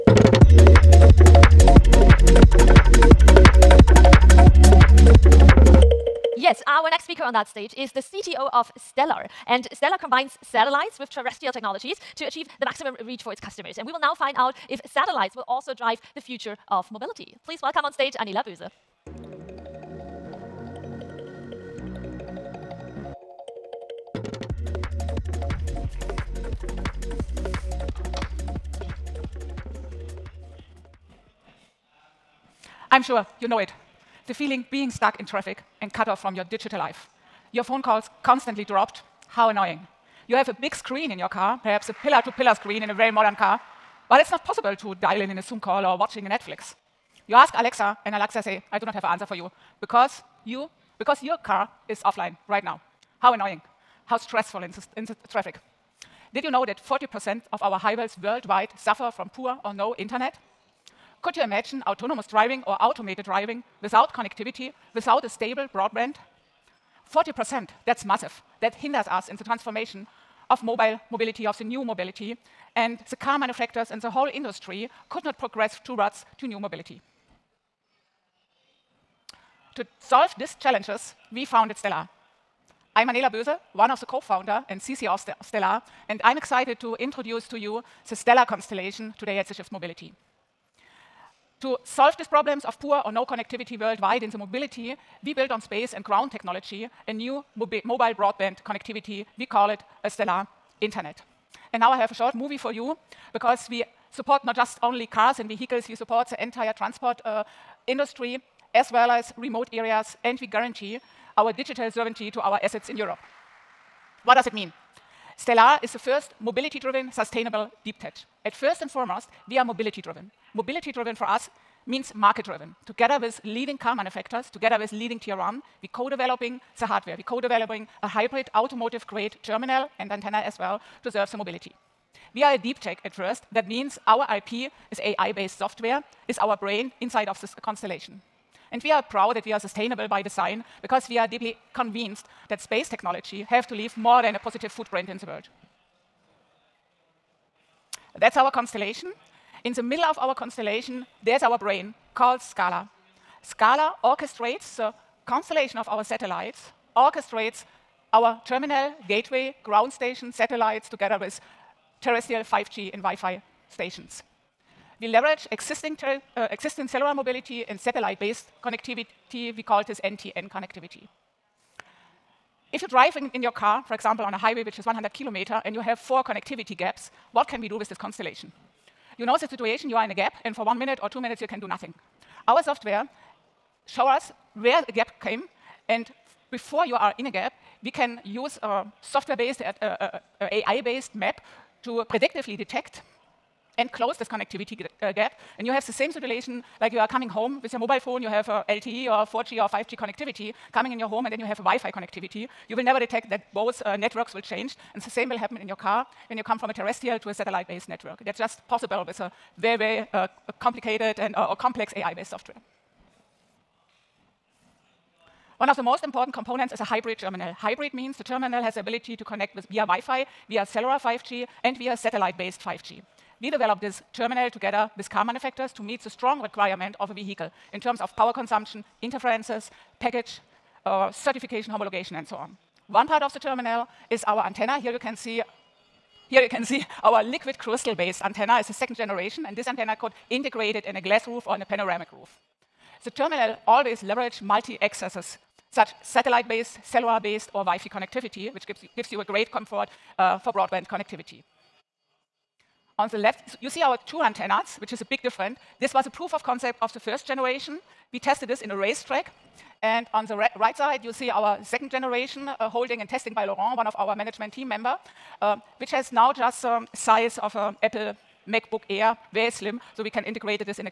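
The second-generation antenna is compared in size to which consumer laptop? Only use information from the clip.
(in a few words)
Apple MacBook Air.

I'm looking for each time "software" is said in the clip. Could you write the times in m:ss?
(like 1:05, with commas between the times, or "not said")
2:15, 3:02, 3:09, 3:32.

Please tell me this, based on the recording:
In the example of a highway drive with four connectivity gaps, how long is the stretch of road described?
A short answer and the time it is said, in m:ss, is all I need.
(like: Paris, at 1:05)
100 kilometers, at 2:54.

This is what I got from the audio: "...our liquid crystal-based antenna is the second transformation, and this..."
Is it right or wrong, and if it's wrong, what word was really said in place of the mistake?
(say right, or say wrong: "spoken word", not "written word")
wrong: "generation", not "transformation".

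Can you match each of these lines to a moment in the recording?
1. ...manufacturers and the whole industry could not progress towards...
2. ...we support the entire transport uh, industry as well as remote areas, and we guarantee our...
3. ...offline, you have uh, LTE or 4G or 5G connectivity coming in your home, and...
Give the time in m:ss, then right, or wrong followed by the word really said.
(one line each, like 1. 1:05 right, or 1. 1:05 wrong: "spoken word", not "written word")
1. 1:13 right
2. 1:45 right
3. 3:17 wrong: "phone", not "offline".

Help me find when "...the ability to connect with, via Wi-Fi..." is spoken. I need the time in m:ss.
3:38.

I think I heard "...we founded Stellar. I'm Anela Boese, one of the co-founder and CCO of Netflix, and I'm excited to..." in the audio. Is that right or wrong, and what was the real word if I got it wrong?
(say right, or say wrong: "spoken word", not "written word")
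wrong: "Stellar", not "Netflix".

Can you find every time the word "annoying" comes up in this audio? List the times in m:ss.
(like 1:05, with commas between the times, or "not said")
0:39, 0:53.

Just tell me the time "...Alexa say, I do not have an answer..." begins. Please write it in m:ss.
0:48.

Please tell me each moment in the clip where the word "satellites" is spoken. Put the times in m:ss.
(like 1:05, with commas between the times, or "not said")
0:10, 0:14, 2:36, 2:40, 2:47, 3:27, 3:41, 4:06.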